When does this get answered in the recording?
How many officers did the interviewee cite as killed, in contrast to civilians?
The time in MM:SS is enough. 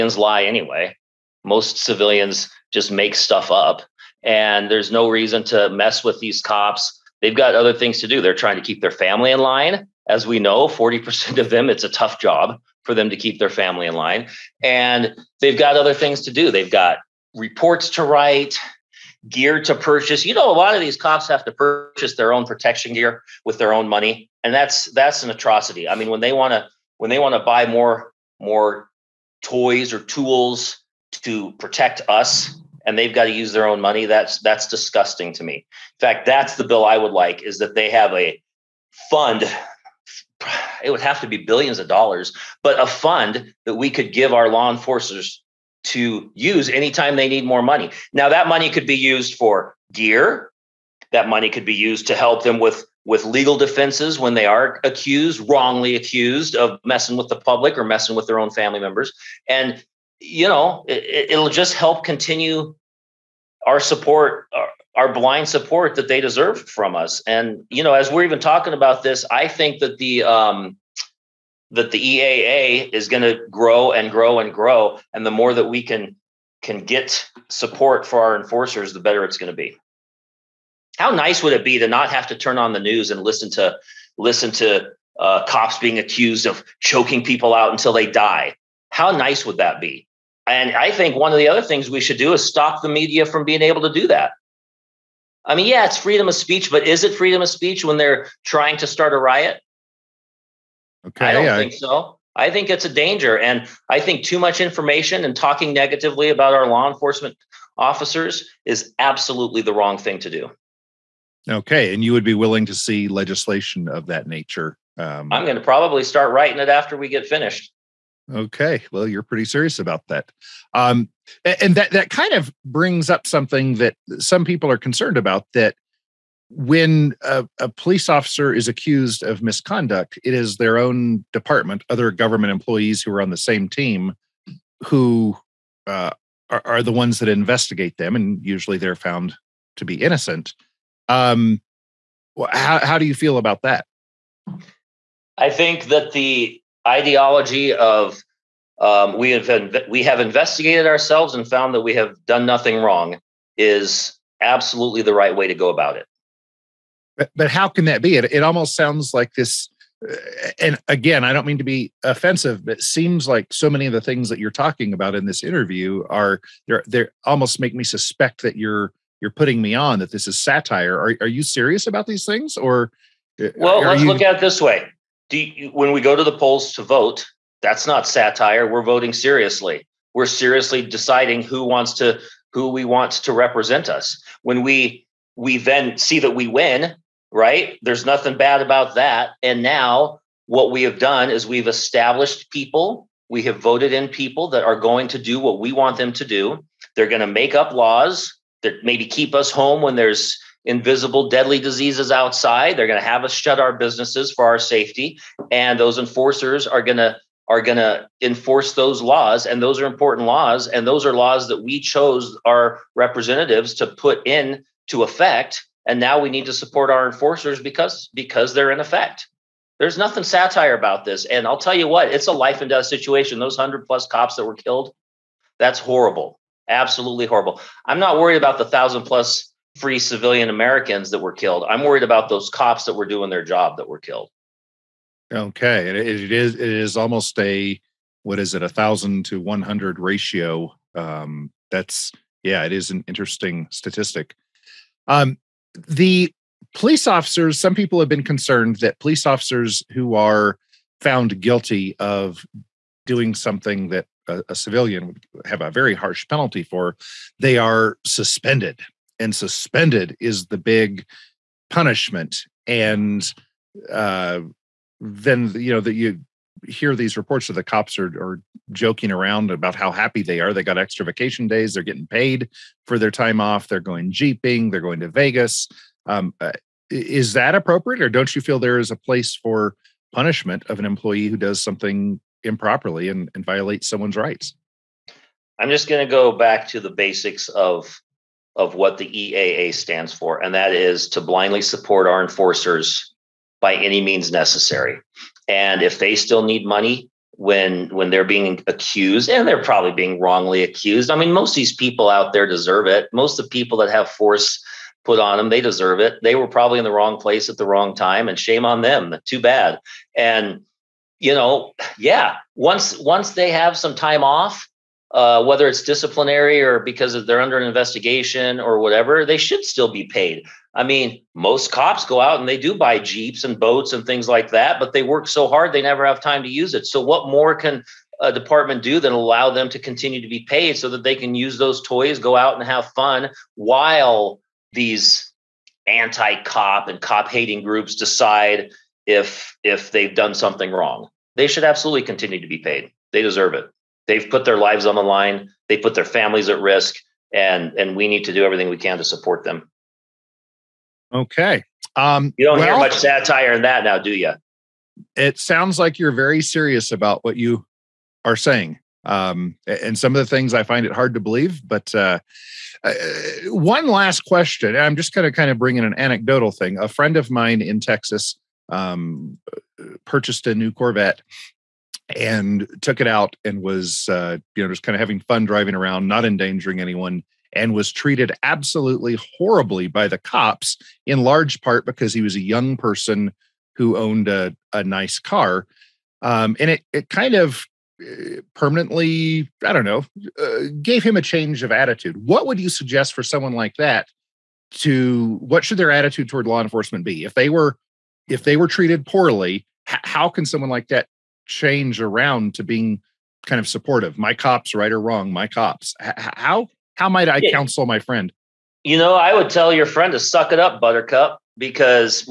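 03:43.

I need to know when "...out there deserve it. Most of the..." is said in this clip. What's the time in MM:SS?
05:02.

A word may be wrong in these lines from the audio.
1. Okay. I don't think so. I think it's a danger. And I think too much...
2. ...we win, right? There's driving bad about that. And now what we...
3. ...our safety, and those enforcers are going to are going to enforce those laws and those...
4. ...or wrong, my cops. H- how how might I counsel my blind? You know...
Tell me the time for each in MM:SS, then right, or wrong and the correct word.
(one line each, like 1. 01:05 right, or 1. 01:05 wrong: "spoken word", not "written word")
1. 01:41 right
2. 03:06 wrong: "nothing", not "driving"
3. 03:24 right
4. 06:44 wrong: "friend", not "blind".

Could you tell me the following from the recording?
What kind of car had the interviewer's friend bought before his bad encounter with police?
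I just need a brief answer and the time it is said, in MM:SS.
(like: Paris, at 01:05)
Corvette, at 06:10.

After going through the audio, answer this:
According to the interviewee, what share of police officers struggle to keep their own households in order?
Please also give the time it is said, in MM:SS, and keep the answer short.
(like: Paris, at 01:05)
40%, at 00:10.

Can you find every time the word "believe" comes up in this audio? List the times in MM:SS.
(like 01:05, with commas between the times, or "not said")
06:01.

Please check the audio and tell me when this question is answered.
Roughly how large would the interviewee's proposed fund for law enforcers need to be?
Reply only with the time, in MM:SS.
00:41.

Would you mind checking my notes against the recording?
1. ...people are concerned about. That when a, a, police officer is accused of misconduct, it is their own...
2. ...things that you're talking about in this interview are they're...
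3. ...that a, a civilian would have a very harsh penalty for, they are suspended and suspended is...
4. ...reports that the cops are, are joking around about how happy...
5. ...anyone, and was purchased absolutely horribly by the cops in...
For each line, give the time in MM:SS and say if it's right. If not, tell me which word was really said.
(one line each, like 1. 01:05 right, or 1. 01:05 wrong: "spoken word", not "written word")
1. 02:04 right
2. 02:44 right
3. 04:13 right
4. 04:27 right
5. 06:16 wrong: "treated", not "purchased".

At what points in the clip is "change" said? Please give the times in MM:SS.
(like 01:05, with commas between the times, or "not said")
06:31, 06:41.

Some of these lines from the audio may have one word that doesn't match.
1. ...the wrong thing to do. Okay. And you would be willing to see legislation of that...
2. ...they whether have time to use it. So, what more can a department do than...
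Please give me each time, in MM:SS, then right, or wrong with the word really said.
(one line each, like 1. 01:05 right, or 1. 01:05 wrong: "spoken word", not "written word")
1. 01:49 right
2. 05:25 wrong: "never", not "whether".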